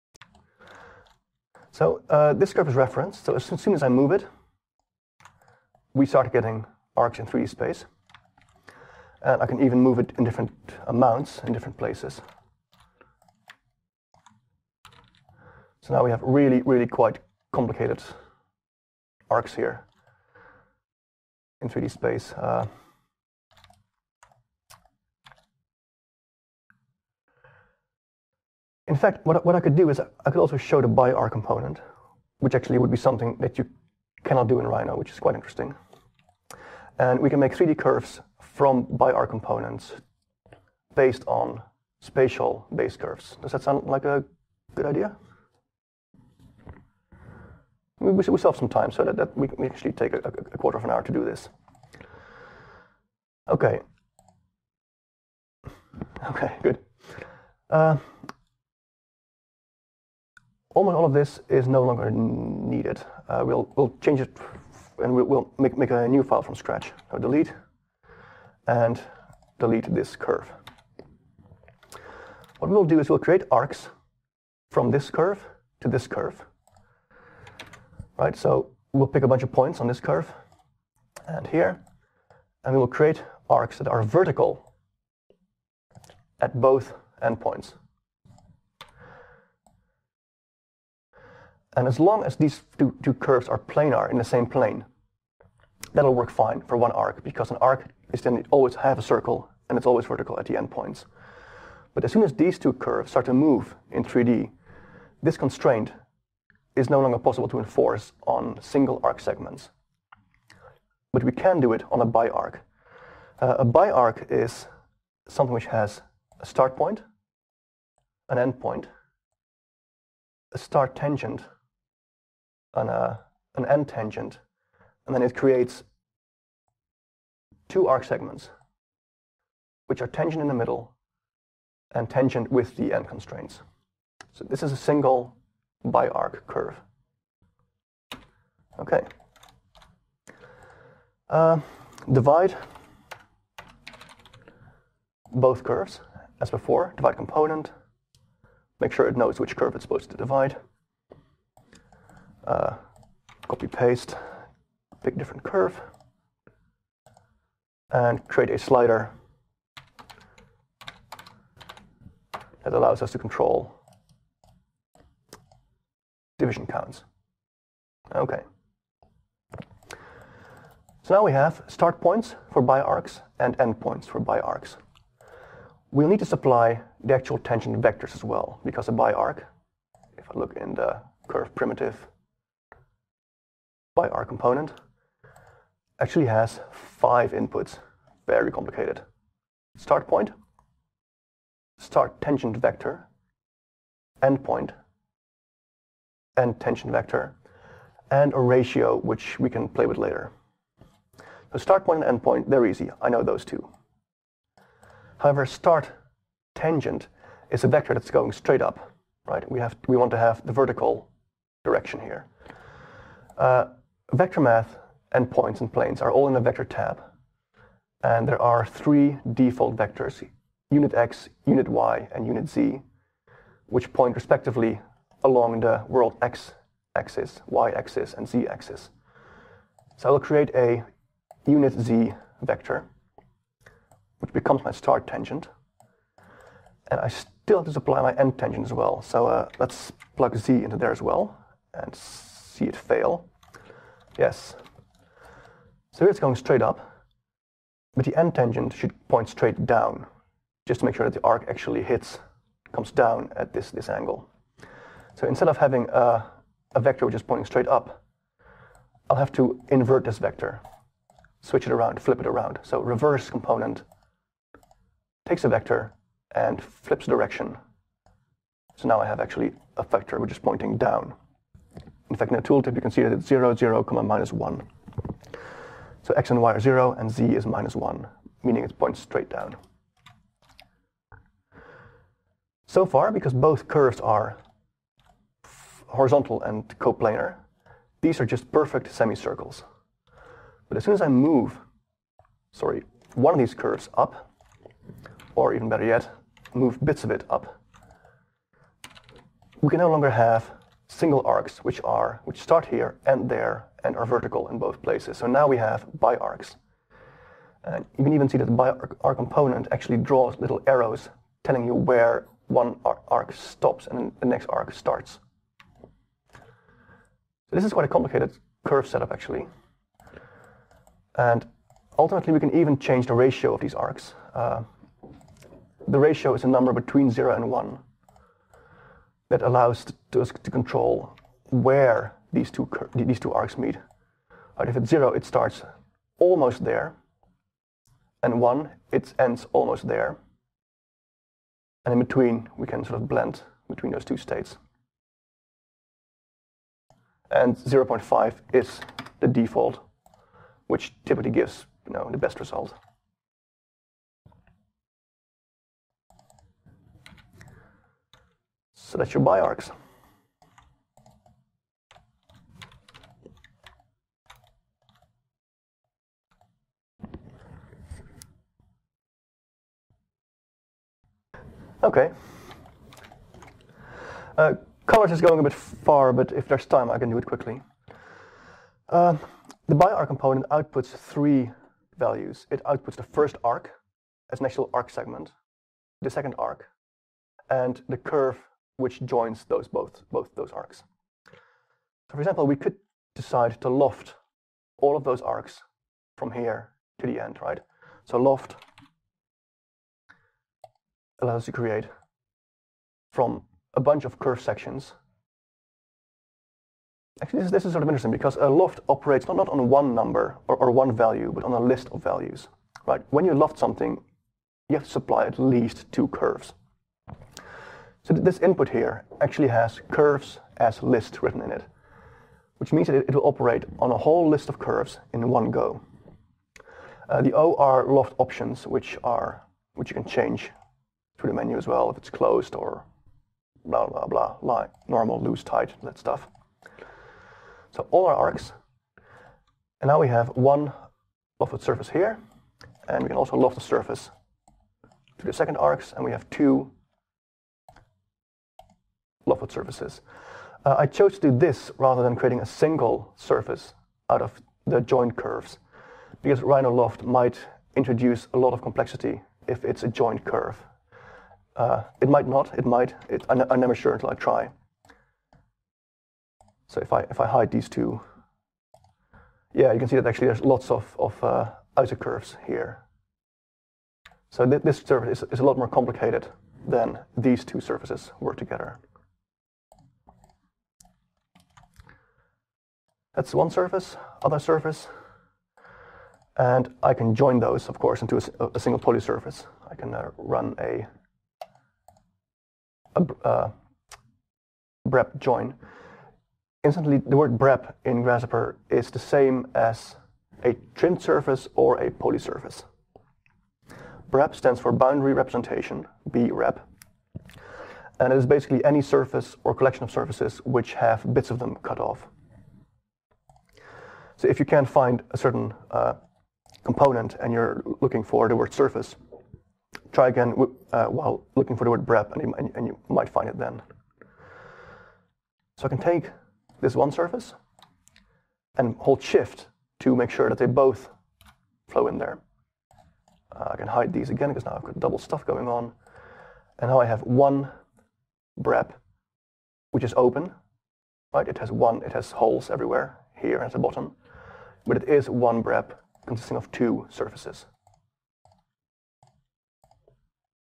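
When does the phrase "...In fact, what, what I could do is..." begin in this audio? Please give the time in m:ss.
0:28.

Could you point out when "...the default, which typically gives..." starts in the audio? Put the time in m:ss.
5:49.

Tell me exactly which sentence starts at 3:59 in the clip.
So uh, let's plug z into there as well and see it fail.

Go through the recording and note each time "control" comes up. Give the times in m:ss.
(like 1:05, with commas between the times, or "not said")
2:43, 5:30.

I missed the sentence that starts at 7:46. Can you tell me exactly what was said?
So if I, if I hide these two, yeah, you can see that actually there's lots of, of uh, outer curves here.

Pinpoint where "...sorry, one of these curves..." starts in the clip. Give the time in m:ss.
4:52.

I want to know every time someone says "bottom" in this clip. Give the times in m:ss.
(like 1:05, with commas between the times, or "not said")
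9:03.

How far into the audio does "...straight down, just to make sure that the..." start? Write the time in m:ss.
4:09.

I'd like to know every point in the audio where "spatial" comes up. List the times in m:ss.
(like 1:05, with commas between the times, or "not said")
0:42.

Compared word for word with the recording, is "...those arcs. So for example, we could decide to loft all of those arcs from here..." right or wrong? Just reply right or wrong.
right.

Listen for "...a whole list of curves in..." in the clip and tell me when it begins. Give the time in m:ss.
7:03.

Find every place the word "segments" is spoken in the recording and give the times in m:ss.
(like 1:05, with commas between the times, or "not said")
1:49, 2:08, 6:24.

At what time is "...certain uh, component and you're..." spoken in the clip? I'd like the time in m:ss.
8:35.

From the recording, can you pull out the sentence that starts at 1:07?
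So delete and delete this curve.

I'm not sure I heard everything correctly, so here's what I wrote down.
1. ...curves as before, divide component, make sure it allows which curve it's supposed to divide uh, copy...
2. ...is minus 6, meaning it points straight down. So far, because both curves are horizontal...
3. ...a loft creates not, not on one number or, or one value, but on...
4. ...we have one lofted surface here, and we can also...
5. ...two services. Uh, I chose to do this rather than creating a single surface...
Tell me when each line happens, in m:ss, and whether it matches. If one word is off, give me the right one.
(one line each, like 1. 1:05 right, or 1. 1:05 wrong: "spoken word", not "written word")
1. 2:25 wrong: "knows", not "allows"
2. 4:37 wrong: "1", not "6"
3. 6:48 wrong: "operates", not "creates"
4. 7:19 right
5. 7:26 right.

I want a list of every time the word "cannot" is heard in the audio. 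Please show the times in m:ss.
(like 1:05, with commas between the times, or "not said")
0:34.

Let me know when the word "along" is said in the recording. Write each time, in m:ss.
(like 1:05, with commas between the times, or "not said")
3:45.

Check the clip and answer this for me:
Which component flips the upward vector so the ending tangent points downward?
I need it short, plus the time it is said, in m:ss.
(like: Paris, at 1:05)
Reverse, at 4:22.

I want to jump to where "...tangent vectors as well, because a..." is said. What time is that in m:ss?
2:57.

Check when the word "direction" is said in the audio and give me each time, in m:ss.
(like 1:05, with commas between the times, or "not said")
3:31, 4:27.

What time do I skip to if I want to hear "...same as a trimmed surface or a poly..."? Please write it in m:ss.
8:18.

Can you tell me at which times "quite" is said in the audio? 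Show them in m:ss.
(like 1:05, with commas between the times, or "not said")
0:16, 0:35, 5:17.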